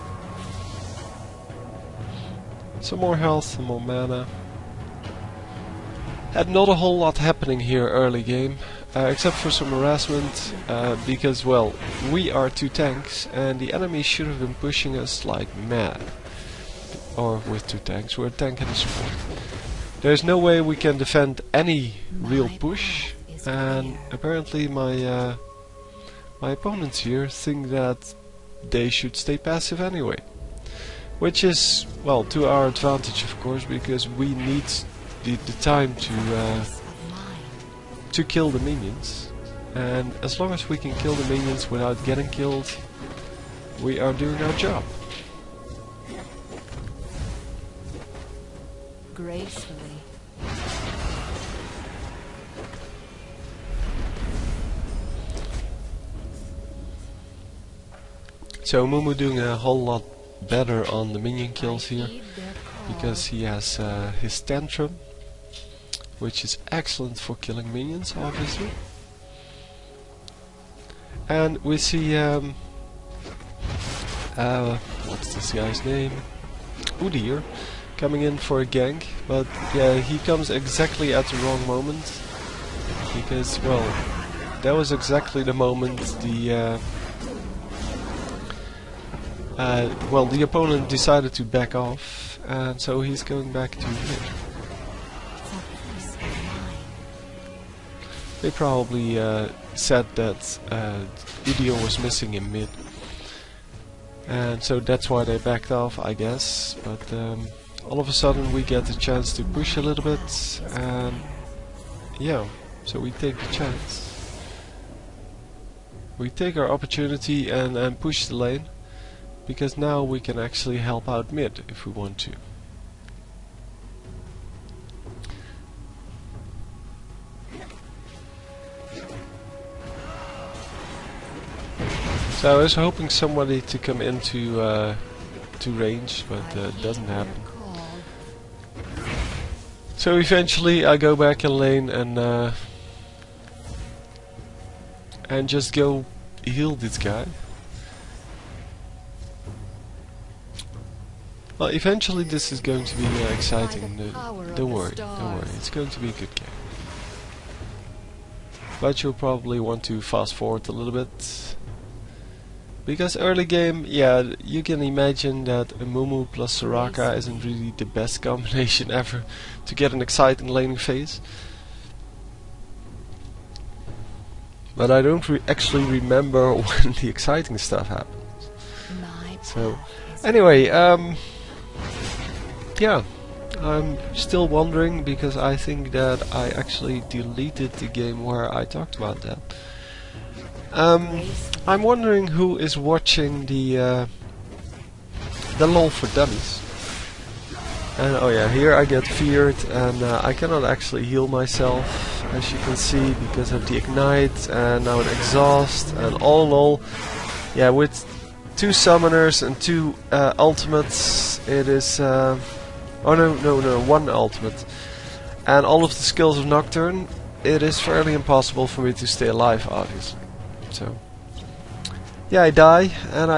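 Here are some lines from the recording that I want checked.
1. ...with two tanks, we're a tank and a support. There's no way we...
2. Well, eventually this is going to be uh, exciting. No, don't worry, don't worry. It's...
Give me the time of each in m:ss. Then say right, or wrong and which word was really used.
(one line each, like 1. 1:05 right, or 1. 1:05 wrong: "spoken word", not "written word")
1. 0:17 right
2. 2:31 right.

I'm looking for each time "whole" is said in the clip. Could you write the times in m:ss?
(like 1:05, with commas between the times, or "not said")
0:06, 0:59.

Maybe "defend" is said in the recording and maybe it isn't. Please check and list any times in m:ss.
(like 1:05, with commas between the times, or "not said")
0:20.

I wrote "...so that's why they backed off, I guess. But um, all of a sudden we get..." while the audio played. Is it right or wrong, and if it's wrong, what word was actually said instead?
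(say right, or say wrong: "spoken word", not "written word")
right.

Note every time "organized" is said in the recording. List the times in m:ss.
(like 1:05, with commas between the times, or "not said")
not said.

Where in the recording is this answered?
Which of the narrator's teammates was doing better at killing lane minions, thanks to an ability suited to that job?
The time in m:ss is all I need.
0:58.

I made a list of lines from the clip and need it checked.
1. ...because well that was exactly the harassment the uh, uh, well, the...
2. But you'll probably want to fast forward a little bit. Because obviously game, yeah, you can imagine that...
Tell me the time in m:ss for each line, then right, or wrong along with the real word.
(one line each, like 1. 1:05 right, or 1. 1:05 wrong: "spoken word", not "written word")
1. 1:23 wrong: "moment", not "harassment"
2. 2:38 wrong: "early", not "obviously".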